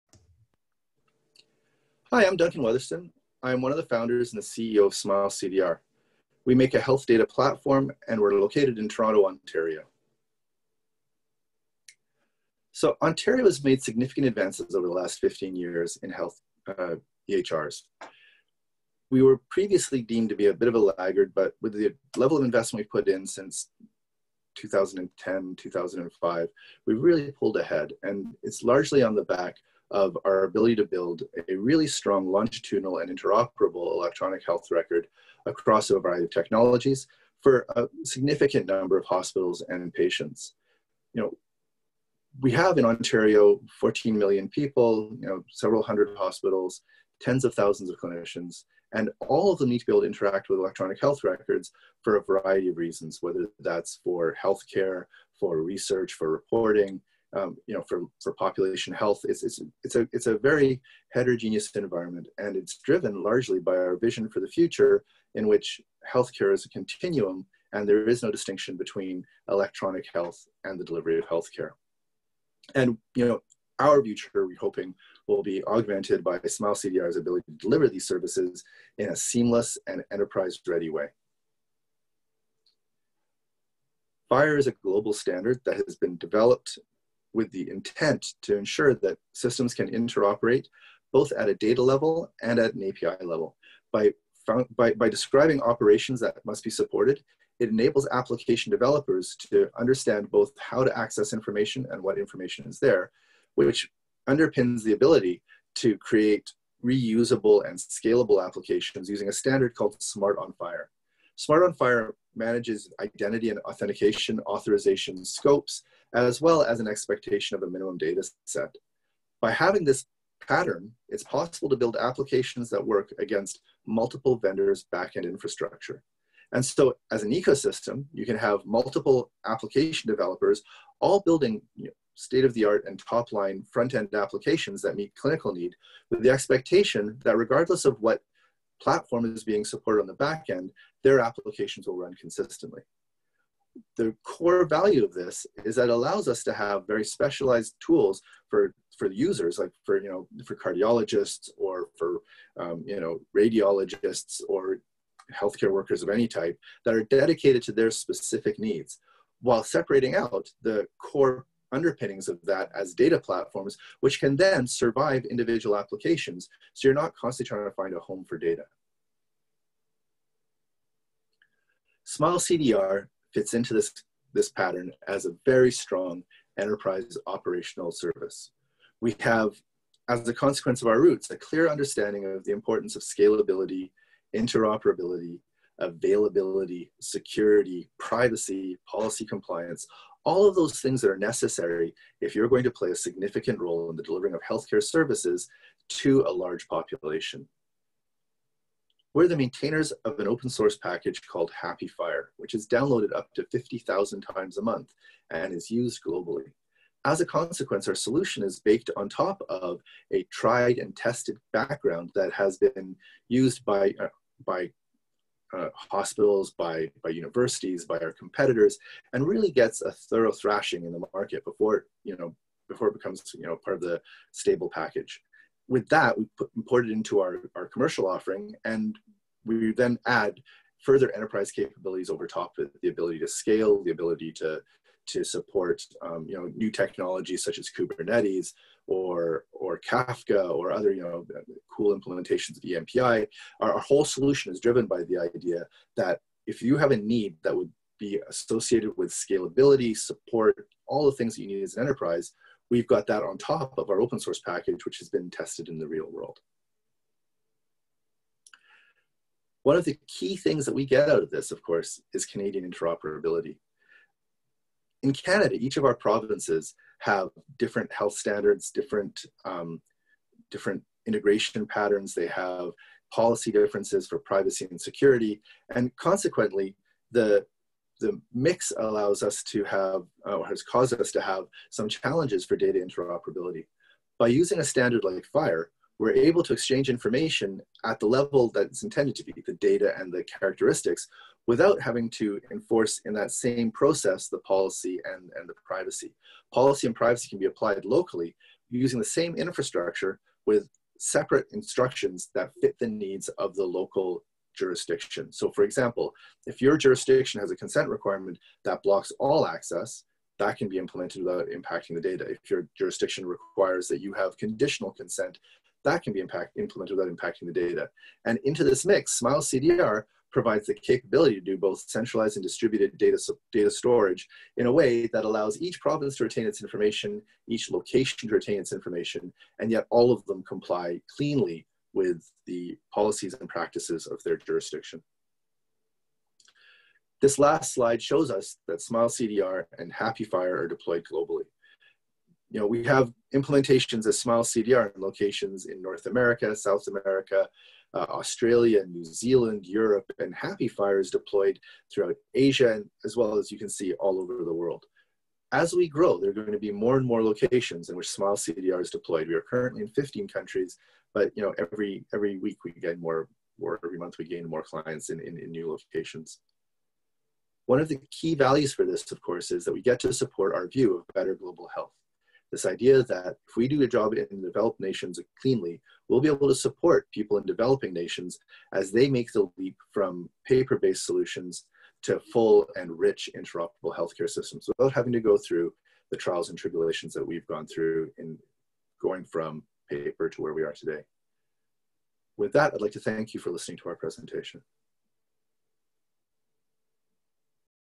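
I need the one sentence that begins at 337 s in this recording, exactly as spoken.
This last slide shows us that Smile CDR and HAPI FHIR are deployed globally.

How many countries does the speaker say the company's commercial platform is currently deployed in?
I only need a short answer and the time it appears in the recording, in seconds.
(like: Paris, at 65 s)
15, at 359 s.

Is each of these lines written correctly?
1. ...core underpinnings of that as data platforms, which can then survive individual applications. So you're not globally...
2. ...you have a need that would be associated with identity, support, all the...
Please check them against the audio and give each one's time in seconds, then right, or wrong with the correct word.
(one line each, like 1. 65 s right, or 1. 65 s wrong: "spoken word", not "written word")
1. 161 s wrong: "constantly", not "globally"
2. 246 s wrong: "scalability", not "identity".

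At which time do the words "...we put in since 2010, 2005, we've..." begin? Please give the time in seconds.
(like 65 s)
22 s.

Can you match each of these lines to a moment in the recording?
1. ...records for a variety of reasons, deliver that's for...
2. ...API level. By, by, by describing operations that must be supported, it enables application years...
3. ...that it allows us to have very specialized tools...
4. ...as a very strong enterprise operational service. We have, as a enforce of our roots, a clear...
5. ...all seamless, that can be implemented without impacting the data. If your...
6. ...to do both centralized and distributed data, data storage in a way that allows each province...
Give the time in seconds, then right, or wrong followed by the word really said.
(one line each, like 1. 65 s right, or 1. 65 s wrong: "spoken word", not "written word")
1. 51 s wrong: "whether", not "deliver"
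2. 92 s wrong: "developers", not "years"
3. 145 s right
4. 175 s wrong: "consequence", not "enforce"
5. 309 s wrong: "access", not "seamless"
6. 321 s right.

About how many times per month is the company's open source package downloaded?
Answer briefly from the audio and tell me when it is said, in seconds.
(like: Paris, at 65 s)
50,000, at 203 s.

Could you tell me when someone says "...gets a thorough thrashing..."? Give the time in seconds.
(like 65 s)
219 s.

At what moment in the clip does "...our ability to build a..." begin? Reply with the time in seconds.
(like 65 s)
30 s.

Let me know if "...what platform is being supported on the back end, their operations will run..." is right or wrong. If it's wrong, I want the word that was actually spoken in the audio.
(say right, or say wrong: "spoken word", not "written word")
wrong: "applications", not "operations".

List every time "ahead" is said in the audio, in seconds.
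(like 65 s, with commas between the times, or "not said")
27 s.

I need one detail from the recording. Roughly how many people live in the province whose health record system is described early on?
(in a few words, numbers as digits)
14 million.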